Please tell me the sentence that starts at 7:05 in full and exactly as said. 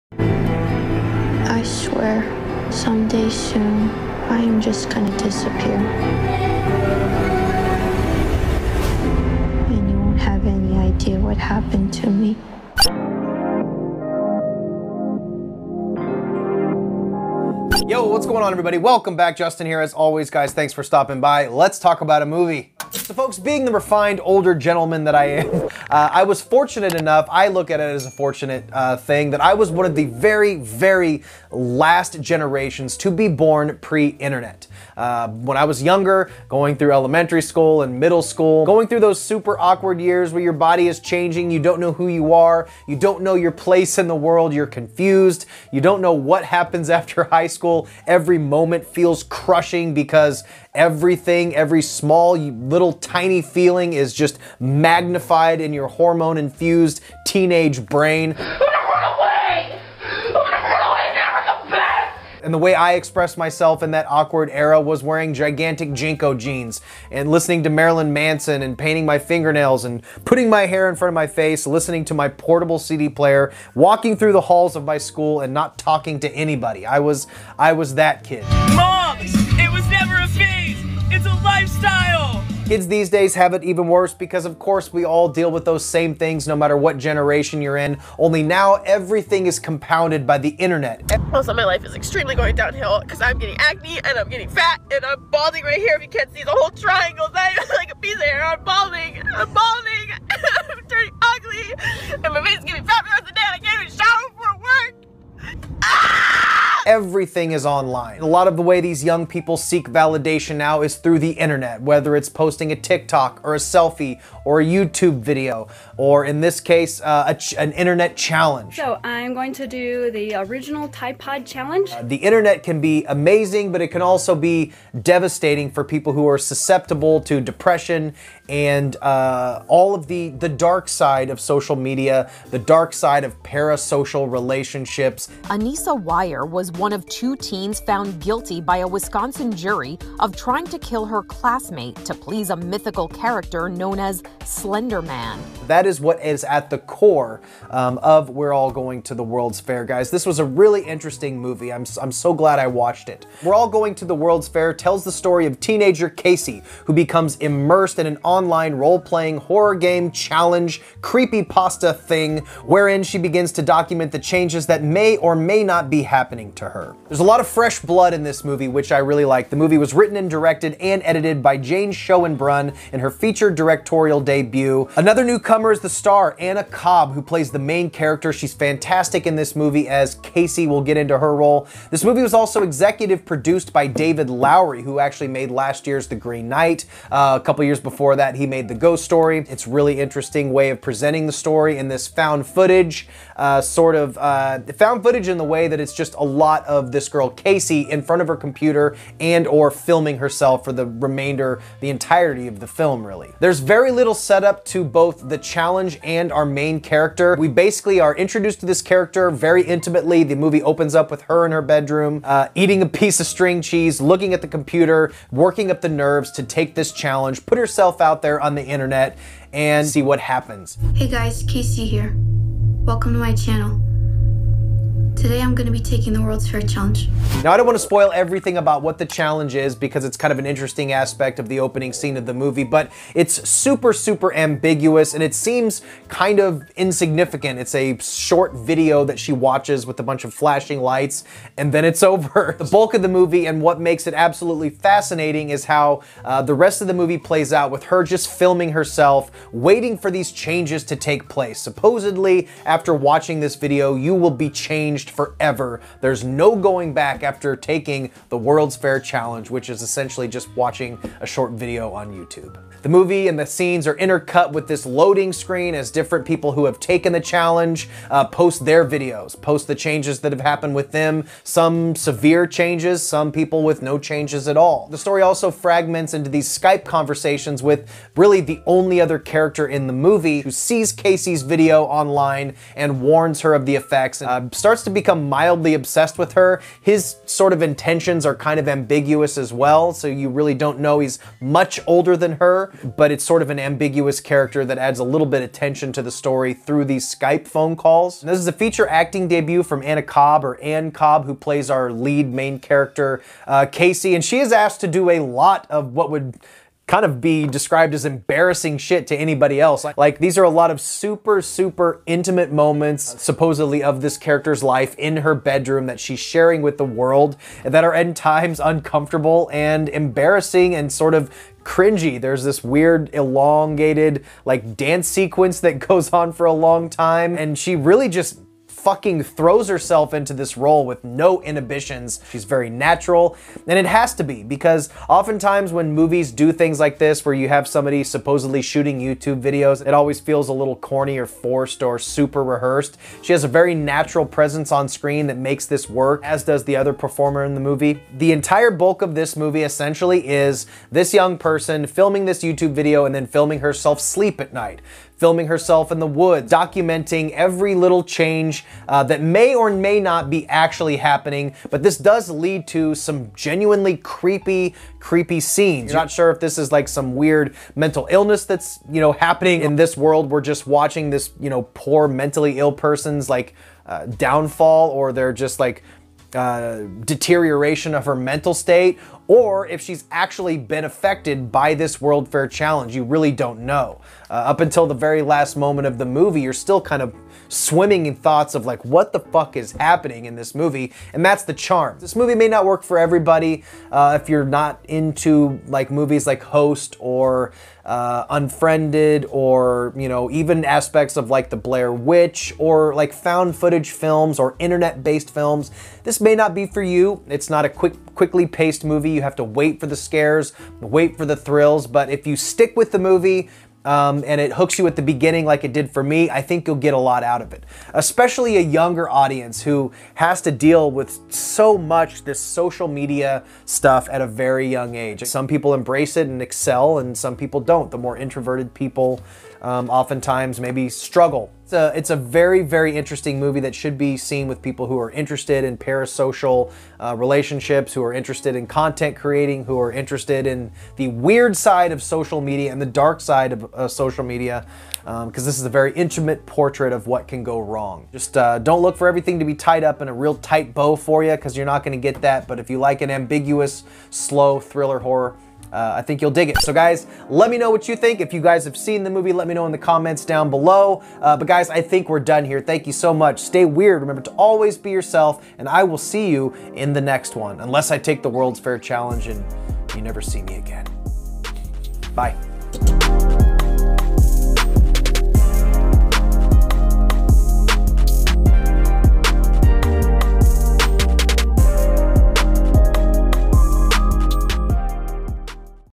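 Some people embrace it and excel, and some people don't.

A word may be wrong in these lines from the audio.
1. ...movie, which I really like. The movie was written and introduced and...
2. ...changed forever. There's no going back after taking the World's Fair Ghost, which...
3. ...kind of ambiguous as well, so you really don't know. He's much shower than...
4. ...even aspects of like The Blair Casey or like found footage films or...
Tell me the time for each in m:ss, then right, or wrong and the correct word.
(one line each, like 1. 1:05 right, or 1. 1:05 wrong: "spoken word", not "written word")
1. 2:48 wrong: "directed", not "introduced"
2. 4:14 wrong: "Challenge", not "Ghost"
3. 4:48 wrong: "older", not "shower"
4. 6:40 wrong: "Witch", not "Casey".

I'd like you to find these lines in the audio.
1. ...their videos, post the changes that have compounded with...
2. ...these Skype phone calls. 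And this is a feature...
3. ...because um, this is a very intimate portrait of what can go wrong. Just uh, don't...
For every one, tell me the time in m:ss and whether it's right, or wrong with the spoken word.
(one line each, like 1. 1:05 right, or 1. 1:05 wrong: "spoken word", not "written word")
1. 4:28 wrong: "happened", not "compounded"
2. 4:56 right
3. 7:24 right.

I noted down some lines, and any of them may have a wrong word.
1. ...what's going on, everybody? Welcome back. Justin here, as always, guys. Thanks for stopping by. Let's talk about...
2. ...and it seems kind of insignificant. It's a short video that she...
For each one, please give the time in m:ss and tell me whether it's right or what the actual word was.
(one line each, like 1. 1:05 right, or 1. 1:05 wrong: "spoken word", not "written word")
1. 0:18 right
2. 3:55 right.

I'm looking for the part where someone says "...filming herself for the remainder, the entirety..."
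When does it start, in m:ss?
3:19.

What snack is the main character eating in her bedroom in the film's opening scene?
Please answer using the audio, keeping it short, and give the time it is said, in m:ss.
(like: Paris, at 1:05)
String cheese, at 3:33.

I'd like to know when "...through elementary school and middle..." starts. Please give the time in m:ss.
0:36.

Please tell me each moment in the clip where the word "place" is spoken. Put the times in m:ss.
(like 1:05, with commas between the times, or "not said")
0:43, 4:11.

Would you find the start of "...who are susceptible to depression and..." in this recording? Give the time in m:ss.
2:06.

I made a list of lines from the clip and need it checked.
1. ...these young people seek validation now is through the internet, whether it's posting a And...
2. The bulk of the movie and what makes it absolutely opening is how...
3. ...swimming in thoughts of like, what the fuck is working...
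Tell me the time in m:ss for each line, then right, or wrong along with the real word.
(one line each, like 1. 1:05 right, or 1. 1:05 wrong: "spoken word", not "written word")
1. 1:48 wrong: "TikTok", not "And"
2. 4:02 wrong: "fascinating", not "opening"
3. 6:27 wrong: "happening", not "working".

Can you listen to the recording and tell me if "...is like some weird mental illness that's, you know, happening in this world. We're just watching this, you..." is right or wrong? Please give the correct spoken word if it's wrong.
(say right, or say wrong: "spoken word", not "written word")
right.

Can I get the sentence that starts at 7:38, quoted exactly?
If you guys have seen the movie, let me know in the comments down below.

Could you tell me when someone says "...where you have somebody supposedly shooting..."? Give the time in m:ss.
5:37.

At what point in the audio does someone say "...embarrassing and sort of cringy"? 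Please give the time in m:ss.
5:19.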